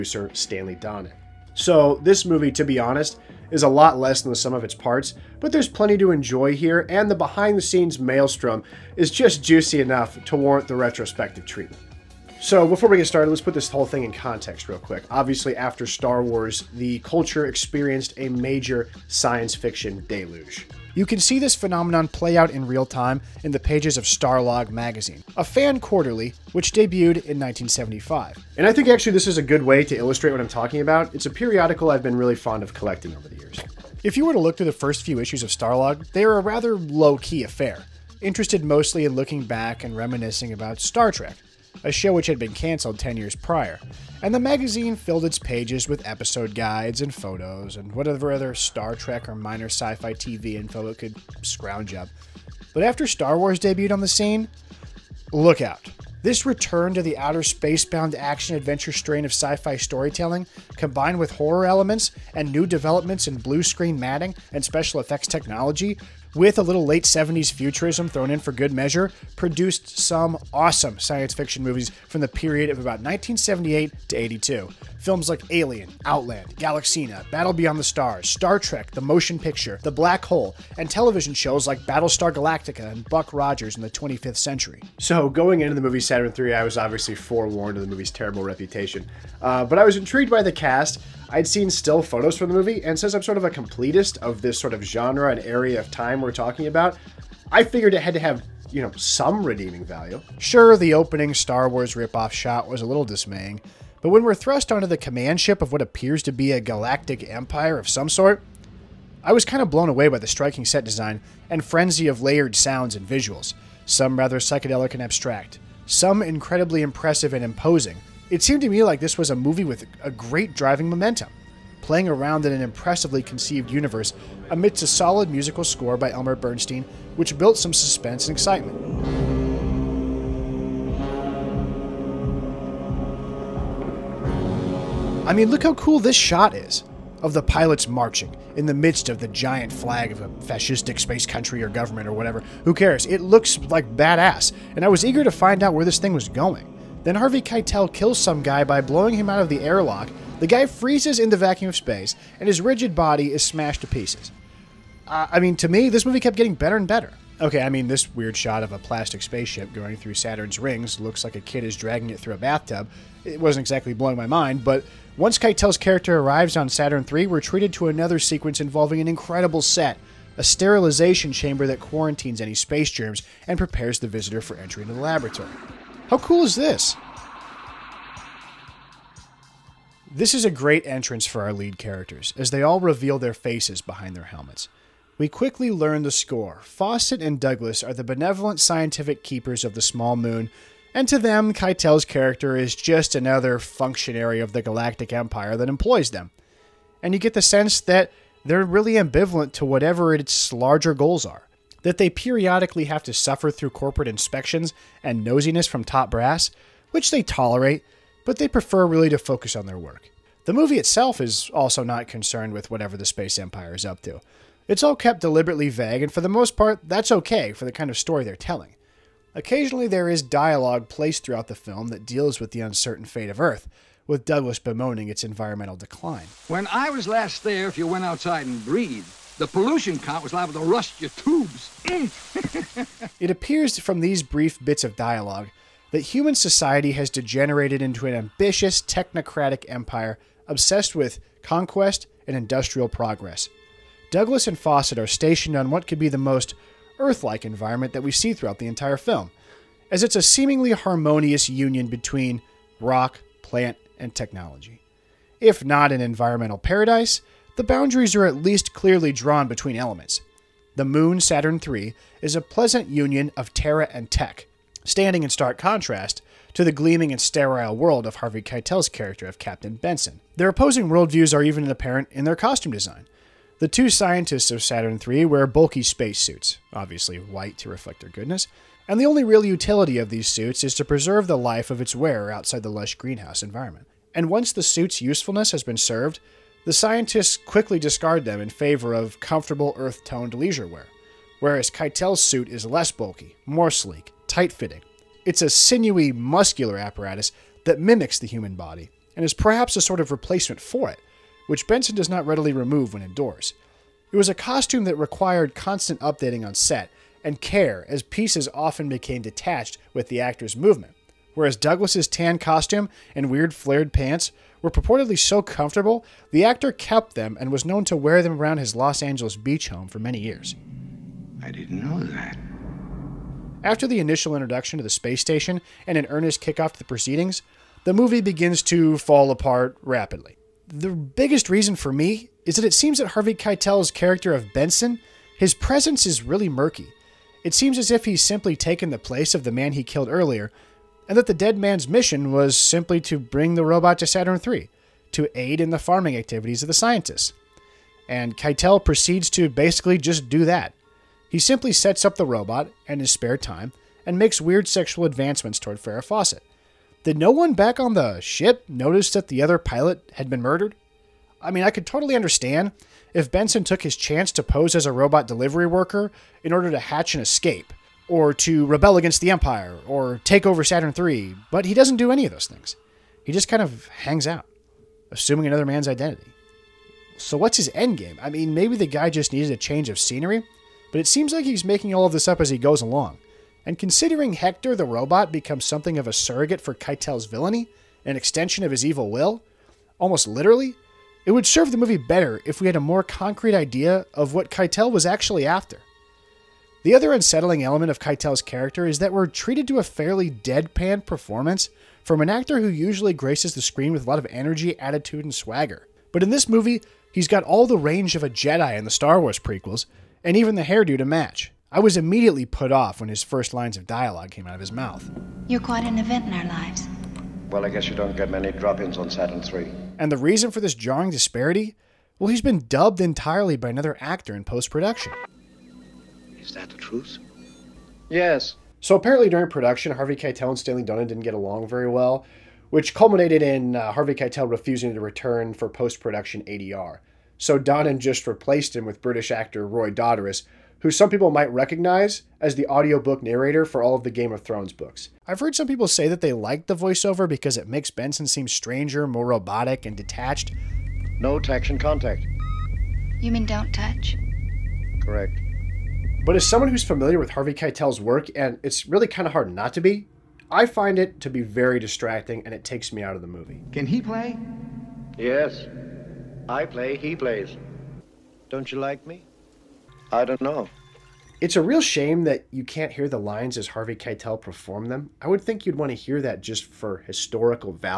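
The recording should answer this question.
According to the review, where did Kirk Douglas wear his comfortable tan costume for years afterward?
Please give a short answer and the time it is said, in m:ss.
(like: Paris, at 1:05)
Los Angeles beach home, at 5:18.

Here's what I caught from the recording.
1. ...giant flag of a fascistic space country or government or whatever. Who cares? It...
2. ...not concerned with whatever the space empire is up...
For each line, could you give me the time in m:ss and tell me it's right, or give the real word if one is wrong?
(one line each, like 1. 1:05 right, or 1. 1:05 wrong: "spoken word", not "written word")
1. 2:19 right
2. 3:31 right.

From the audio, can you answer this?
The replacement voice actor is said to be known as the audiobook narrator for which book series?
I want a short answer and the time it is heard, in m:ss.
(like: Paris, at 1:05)
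Game of Thrones, at 7:24.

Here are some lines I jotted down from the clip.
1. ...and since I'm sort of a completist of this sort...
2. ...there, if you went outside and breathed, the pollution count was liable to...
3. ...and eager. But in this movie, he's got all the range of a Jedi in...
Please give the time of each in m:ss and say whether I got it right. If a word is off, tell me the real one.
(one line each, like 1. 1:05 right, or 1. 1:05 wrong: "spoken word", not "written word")
1. 1:32 right
2. 3:47 right
3. 6:45 wrong: "swagger", not "eager".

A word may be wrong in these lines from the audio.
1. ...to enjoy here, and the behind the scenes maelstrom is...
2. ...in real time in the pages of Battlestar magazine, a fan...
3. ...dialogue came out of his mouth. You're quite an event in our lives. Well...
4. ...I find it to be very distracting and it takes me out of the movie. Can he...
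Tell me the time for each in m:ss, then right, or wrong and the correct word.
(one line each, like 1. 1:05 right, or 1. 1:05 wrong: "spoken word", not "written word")
1. 0:05 right
2. 0:22 wrong: "Starlog", not "Battlestar"
3. 6:53 right
4. 7:40 right.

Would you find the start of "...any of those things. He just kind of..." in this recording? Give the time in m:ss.
6:12.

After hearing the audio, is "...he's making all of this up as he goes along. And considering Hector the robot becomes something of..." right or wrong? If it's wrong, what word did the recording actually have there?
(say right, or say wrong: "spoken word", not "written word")
right.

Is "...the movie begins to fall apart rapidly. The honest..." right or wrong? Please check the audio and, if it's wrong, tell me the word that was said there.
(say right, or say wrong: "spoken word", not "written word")
wrong: "biggest", not "honest".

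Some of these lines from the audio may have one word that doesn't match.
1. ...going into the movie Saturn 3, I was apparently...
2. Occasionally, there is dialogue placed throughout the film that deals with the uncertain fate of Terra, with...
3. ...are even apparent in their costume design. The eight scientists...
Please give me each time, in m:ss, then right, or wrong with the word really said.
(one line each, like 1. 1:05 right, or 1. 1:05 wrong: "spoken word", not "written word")
1. 1:25 wrong: "obviously", not "apparently"
2. 3:39 wrong: "Earth", not "Terra"
3. 4:31 wrong: "two", not "eight".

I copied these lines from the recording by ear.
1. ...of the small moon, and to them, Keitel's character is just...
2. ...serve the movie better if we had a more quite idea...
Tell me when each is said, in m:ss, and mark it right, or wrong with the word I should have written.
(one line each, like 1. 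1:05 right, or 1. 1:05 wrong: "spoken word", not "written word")
1. 3:09 right
2. 6:31 wrong: "concrete", not "quite".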